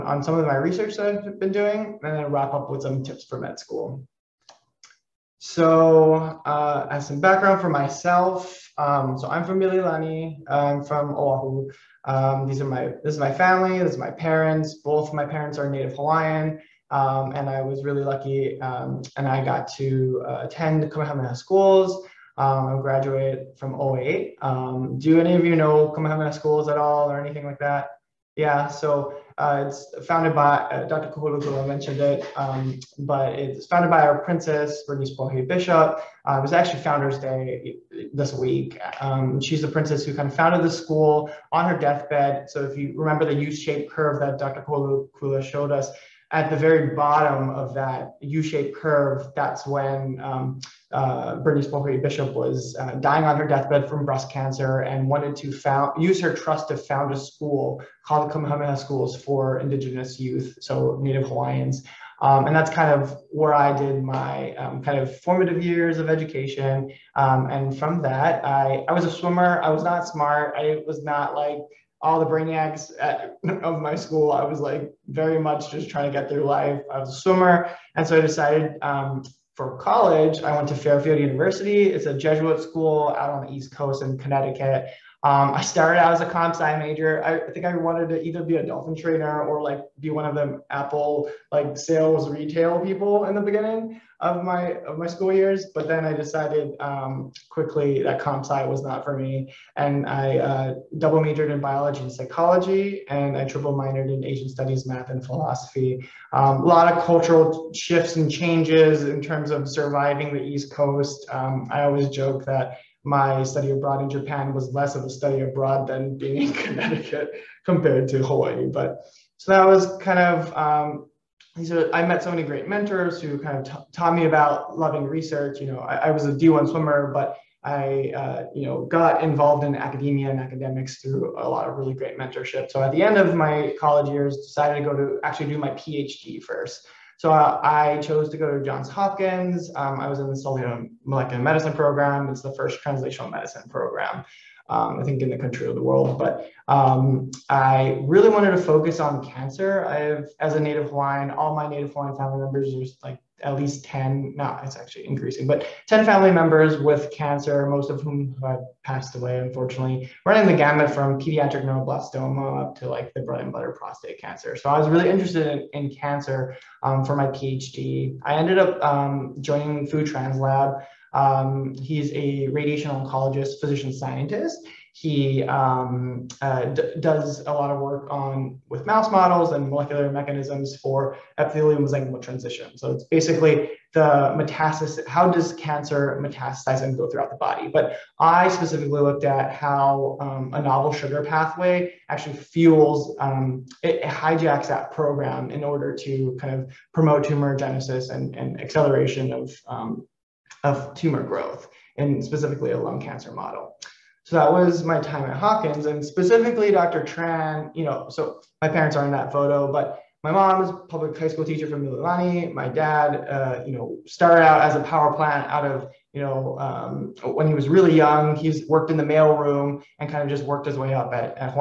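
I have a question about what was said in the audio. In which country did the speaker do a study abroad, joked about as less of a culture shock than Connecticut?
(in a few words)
Japan.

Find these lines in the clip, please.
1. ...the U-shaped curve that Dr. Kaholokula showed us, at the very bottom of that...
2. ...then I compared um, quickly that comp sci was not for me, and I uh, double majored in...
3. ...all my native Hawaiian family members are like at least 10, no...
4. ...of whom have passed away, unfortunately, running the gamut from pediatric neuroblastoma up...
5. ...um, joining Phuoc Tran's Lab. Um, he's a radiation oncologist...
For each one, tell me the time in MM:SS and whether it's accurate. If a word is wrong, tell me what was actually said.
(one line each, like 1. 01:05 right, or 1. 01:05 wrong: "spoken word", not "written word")
1. 00:43 right
2. 01:35 wrong: "decided", not "compared"
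3. 02:31 right
4. 02:37 right
5. 02:48 right.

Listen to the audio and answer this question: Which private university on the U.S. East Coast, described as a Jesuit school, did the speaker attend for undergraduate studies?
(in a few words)
Fairfield University.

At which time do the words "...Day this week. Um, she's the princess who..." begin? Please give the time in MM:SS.
00:37.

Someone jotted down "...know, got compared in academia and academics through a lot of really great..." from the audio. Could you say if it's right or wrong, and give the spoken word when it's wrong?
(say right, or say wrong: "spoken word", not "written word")
wrong: "involved", not "compared".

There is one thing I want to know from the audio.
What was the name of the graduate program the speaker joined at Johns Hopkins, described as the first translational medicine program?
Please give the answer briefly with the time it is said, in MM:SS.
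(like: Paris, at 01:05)
Molecular medicine, at 02:21.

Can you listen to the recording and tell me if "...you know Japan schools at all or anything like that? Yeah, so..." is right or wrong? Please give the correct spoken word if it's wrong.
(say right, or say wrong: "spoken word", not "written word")
wrong: "Kamehameha", not "Japan".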